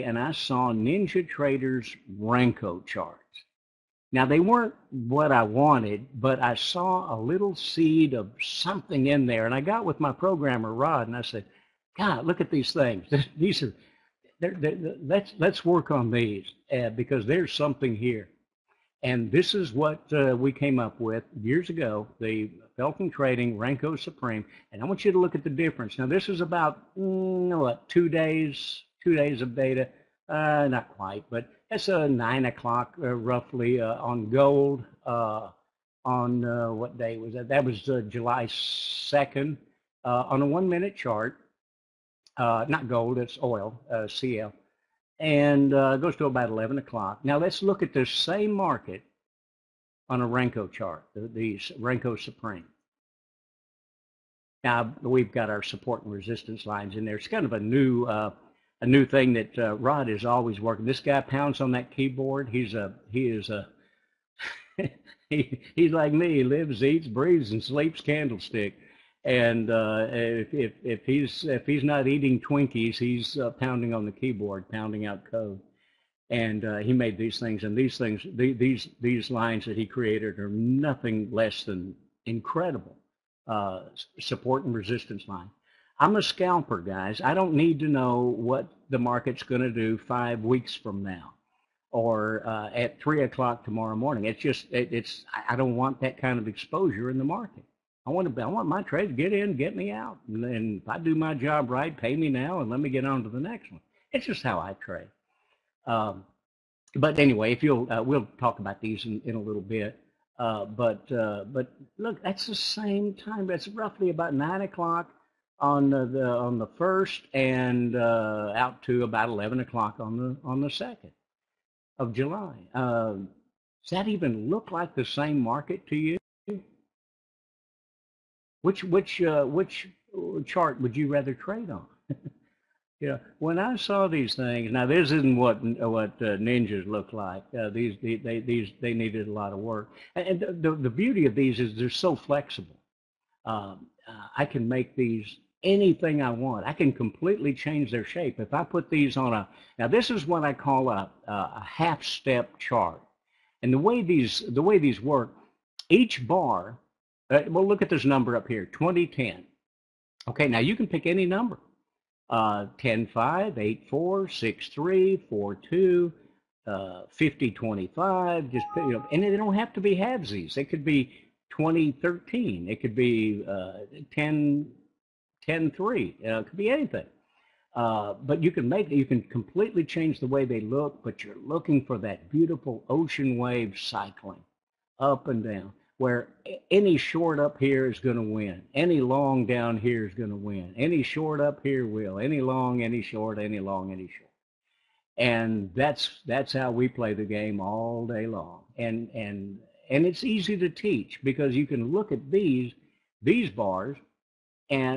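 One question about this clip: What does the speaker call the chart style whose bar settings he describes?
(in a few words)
half step chart.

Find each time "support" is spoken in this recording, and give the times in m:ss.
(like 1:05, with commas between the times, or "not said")
0:55, 1:24.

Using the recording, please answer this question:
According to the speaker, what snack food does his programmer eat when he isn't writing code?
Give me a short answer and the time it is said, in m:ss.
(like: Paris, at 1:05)
Twinkies, at 1:12.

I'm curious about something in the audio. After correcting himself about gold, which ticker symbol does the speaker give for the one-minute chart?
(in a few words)
CL.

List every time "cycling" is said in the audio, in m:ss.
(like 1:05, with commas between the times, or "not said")
3:03.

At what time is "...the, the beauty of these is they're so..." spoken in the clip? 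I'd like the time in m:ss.
2:20.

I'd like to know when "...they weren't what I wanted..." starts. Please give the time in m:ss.
0:04.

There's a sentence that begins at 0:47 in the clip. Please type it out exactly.
Now let's look at the same market on a Renko chart, the, the Renko Supreme.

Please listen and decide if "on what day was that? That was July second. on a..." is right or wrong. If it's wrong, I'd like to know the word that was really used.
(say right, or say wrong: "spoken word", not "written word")
right.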